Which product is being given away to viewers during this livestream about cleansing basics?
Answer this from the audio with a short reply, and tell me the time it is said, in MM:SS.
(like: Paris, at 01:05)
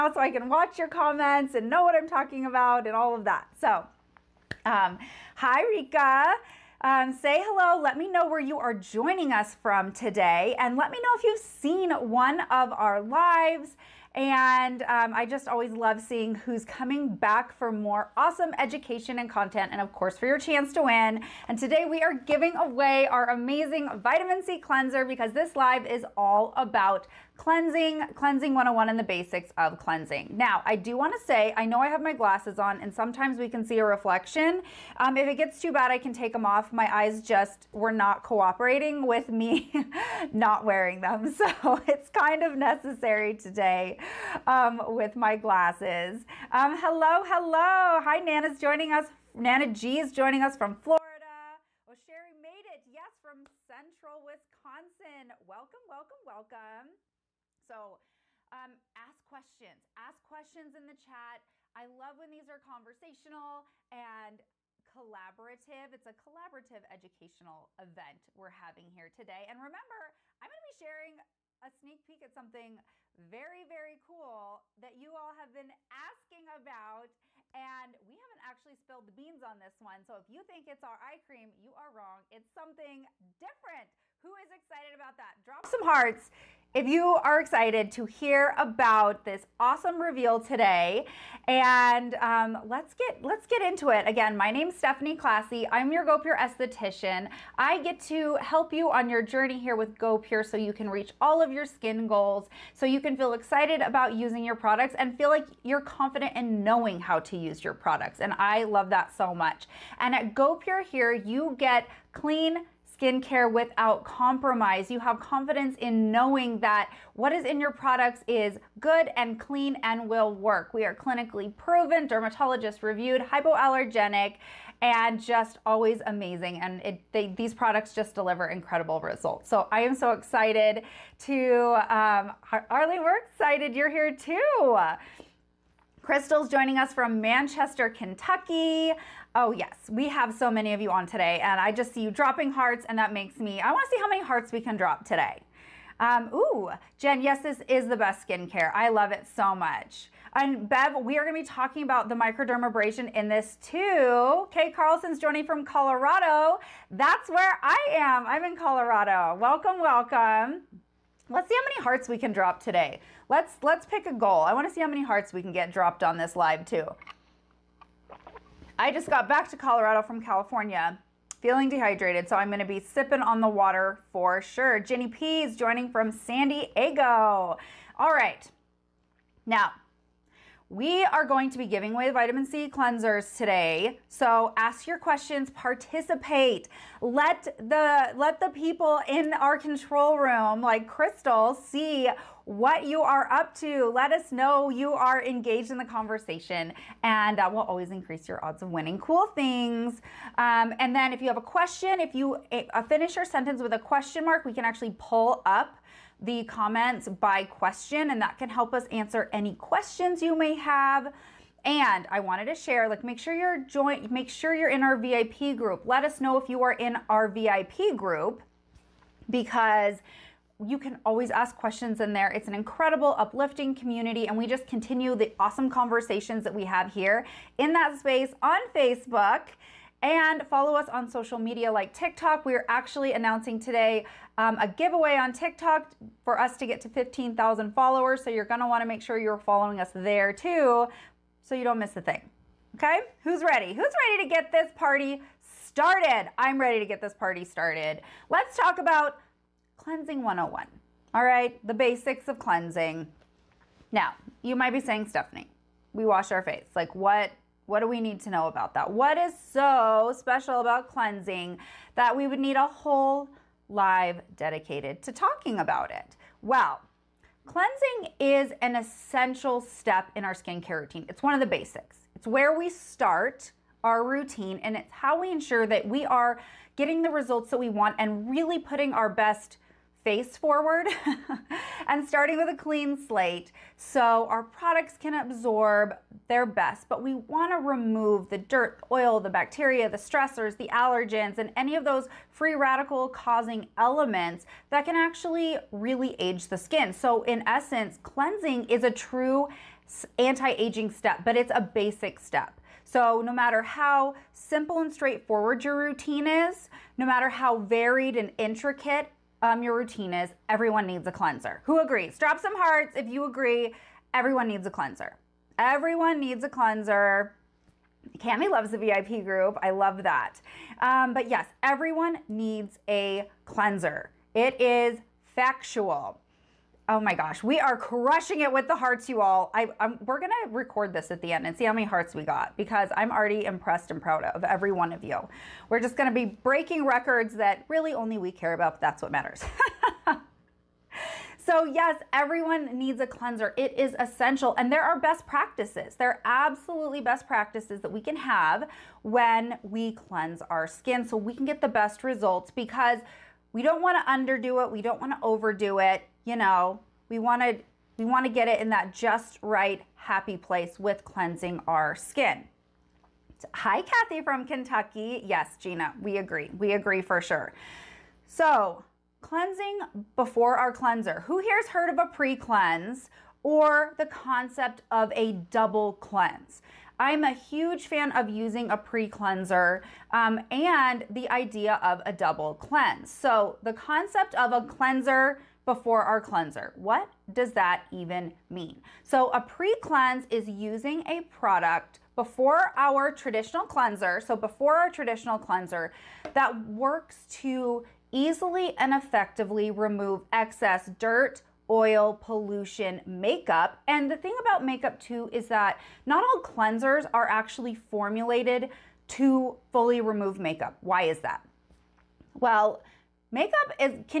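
Vitamin C cleanser, at 00:23.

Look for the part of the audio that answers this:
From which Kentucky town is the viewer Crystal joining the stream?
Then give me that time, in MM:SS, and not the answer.
02:17.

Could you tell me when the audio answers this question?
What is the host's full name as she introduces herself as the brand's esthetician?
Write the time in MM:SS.
01:34.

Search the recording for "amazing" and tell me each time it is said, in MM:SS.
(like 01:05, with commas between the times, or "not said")
00:23, 02:06.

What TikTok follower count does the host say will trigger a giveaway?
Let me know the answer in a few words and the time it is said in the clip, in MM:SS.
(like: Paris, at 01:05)
15,000, at 03:56.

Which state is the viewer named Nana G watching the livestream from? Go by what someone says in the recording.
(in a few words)
Florida.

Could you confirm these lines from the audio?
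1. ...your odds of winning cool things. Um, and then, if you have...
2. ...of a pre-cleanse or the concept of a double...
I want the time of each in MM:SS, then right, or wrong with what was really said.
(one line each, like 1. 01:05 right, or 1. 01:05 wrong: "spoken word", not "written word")
1. 03:18 right
2. 06:11 right.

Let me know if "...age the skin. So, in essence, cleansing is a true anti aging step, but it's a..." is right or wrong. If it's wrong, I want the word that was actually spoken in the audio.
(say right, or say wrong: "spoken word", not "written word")
right.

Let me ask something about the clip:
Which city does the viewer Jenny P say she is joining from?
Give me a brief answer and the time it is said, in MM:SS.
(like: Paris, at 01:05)
San Diego, at 02:56.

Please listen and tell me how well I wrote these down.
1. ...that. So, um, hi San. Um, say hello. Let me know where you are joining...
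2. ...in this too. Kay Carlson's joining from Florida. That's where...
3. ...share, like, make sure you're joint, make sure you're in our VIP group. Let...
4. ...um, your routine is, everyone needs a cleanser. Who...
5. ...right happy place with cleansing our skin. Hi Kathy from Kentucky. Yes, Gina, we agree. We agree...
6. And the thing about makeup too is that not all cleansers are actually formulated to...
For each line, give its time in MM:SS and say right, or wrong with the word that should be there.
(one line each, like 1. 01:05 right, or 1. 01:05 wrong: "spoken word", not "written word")
1. 00:03 wrong: "Rika", not "San"
2. 02:33 wrong: "Colorado", not "Florida"
3. 03:32 right
4. 05:09 right
5. 05:59 right
6. 06:43 right.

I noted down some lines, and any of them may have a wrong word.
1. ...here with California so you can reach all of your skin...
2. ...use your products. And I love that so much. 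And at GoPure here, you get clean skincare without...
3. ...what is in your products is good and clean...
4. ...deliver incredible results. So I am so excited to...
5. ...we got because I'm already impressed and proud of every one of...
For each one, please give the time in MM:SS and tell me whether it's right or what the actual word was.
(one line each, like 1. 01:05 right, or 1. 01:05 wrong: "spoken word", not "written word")
1. 01:39 wrong: "GoPure", not "California"
2. 01:47 right
3. 01:57 right
4. 02:08 right
5. 05:32 right.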